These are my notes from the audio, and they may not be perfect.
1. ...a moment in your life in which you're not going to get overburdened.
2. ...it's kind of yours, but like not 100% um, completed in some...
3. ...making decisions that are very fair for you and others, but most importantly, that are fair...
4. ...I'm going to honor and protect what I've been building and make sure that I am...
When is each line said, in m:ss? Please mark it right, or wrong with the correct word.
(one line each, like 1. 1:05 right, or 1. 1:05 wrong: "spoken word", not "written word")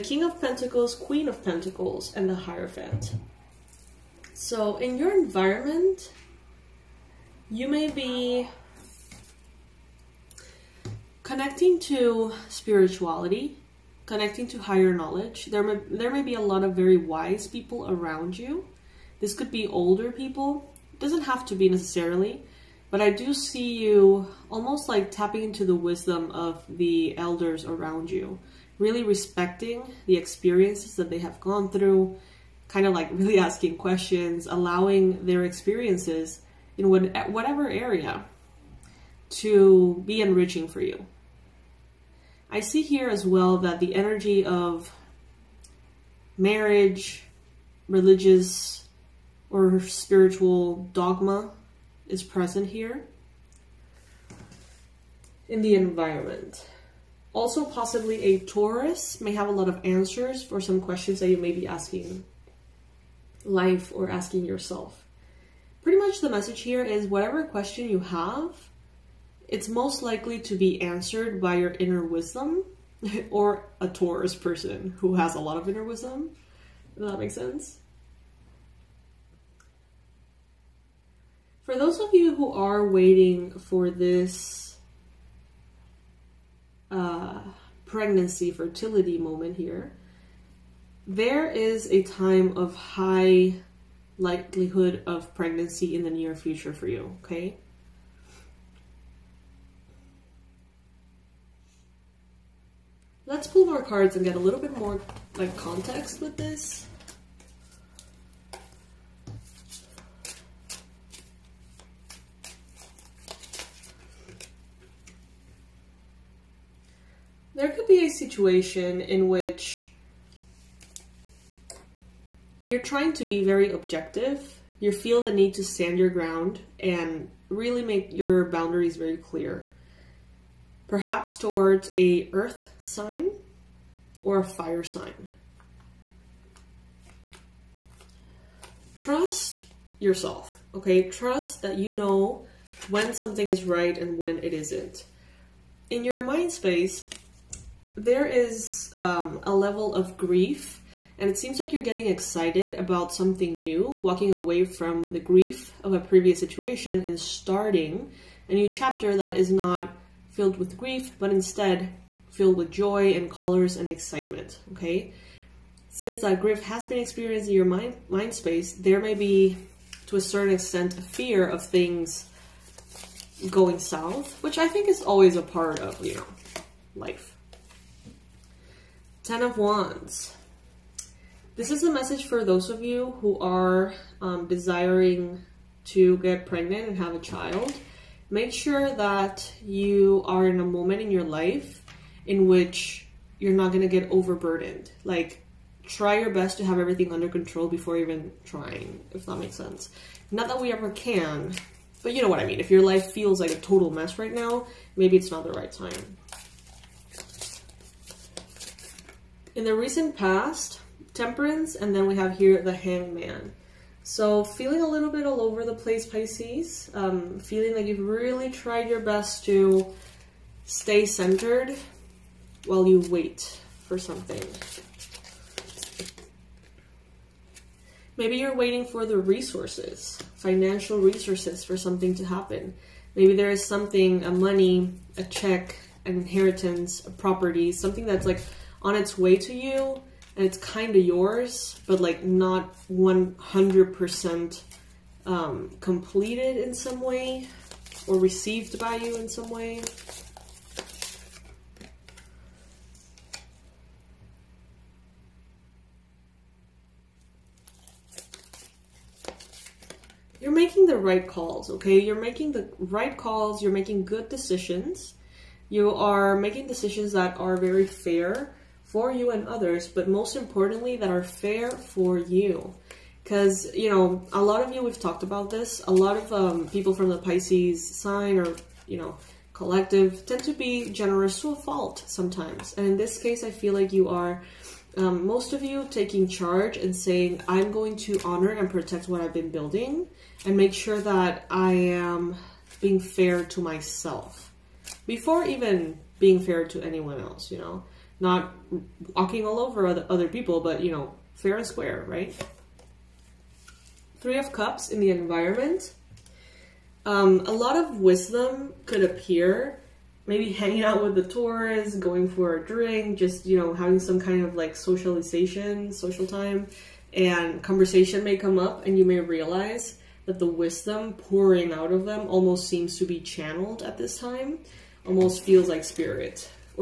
1. 3:10 right
2. 4:00 right
3. 4:26 right
4. 4:47 right.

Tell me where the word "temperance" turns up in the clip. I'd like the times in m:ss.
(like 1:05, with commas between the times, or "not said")
3:31.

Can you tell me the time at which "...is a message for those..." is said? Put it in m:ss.
3:01.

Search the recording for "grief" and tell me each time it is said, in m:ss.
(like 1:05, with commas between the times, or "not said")
2:30, 2:35, 2:40, 2:46.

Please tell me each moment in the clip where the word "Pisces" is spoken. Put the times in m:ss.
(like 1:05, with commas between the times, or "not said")
3:36, 4:37.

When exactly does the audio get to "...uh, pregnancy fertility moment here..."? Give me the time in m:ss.
1:26.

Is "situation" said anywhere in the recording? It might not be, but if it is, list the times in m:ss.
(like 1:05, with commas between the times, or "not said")
1:58, 2:36.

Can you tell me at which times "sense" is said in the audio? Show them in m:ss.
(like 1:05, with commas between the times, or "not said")
1:17, 3:19.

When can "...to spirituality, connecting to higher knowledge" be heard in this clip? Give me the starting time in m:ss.
0:11.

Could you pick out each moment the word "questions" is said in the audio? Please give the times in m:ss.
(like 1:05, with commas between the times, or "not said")
0:33, 1:00, 1:07.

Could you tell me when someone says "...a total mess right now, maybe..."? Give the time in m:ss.
3:23.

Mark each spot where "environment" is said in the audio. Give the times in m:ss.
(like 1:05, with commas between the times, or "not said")
0:05, 0:55, 5:05.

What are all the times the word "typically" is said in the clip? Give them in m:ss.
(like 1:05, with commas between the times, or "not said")
not said.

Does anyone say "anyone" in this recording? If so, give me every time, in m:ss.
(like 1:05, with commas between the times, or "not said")
4:56.